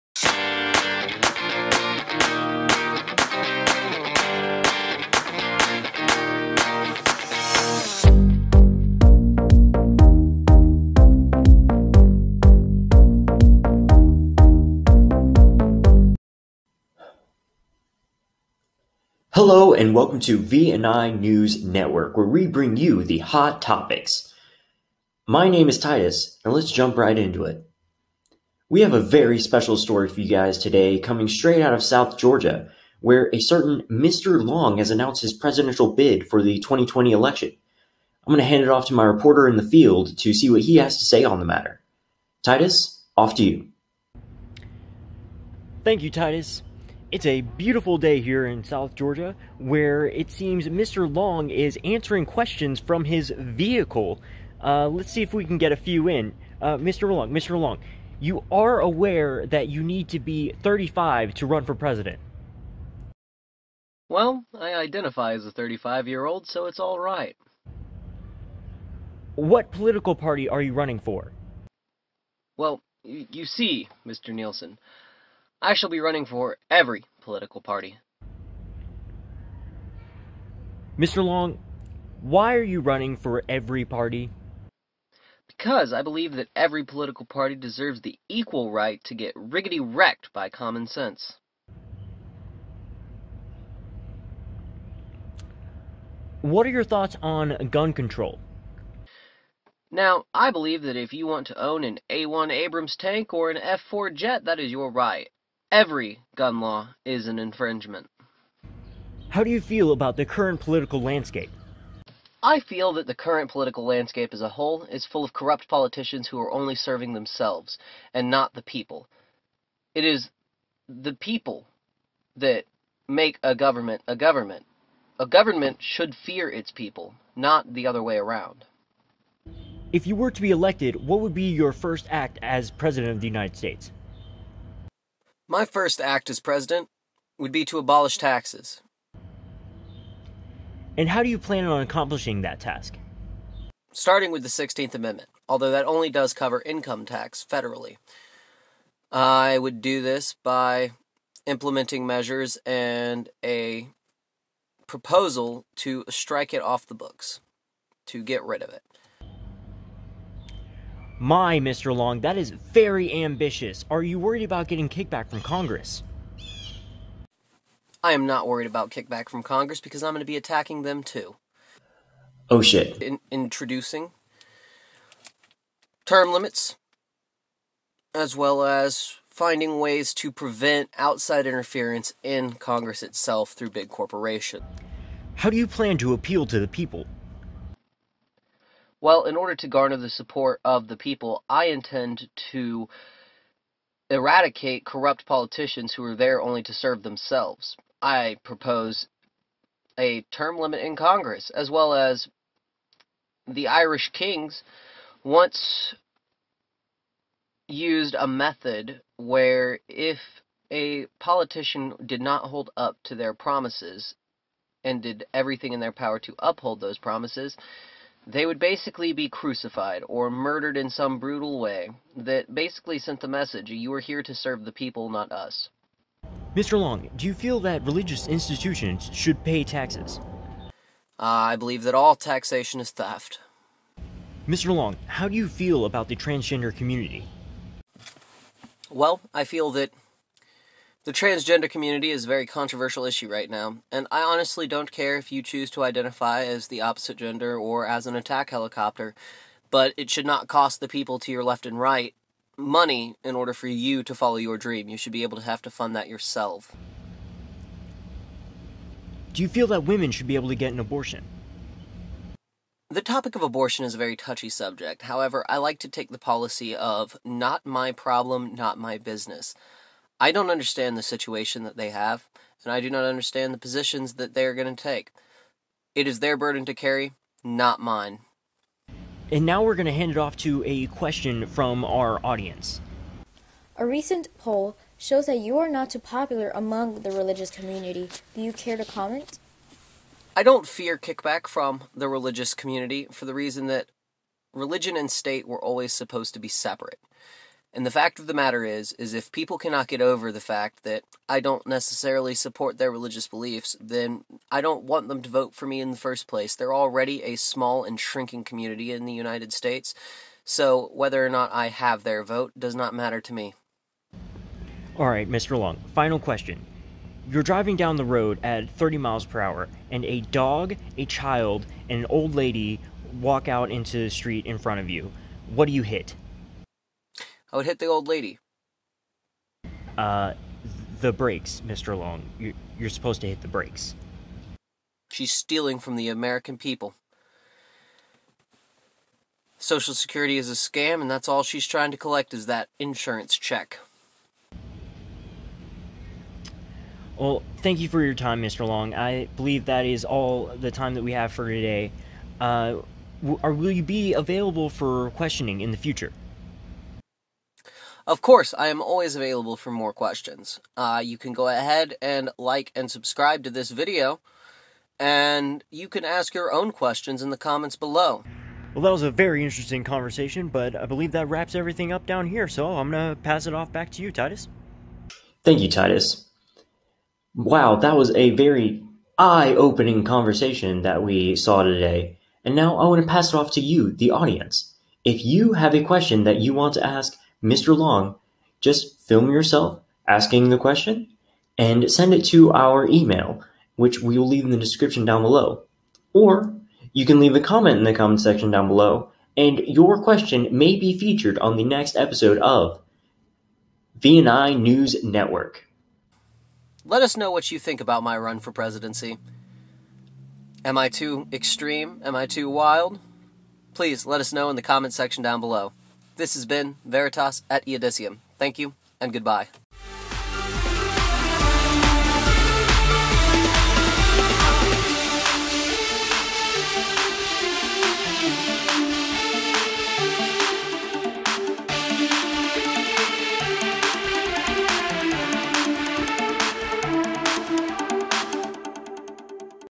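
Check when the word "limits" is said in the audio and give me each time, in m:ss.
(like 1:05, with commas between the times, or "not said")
2:56, 3:20.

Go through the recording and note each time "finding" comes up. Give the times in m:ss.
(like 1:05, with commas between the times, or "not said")
2:59.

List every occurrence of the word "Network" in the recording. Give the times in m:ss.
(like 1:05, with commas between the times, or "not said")
0:21, 6:45.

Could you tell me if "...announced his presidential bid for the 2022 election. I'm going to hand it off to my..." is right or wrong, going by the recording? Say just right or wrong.
wrong.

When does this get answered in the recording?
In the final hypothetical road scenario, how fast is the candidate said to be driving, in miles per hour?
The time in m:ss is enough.
5:18.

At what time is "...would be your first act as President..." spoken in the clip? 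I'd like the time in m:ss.
2:11.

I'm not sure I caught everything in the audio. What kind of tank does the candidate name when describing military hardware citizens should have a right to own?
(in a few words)
A1 Abrams.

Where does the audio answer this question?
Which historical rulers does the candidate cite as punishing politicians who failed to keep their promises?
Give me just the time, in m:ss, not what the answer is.
3:23.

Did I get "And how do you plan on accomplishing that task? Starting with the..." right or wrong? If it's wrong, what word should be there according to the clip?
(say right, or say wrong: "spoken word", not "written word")
right.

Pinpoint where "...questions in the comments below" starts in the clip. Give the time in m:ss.
6:06.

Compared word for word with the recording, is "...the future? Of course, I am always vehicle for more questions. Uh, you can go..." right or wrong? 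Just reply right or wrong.
wrong.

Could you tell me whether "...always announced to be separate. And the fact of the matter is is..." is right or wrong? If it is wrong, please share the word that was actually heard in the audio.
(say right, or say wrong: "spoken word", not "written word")
wrong: "supposed", not "announced".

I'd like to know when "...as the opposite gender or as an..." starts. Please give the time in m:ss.
4:06.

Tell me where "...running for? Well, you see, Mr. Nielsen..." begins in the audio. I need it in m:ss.
1:10.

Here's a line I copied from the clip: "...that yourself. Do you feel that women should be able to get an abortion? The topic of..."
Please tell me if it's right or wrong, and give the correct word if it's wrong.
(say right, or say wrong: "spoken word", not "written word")
right.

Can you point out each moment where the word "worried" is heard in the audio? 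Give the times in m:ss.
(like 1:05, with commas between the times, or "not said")
2:44, 2:48.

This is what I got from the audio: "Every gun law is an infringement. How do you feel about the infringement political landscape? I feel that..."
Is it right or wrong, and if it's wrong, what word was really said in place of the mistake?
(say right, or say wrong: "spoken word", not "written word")
wrong: "current", not "infringement".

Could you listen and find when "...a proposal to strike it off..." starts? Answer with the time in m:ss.
2:33.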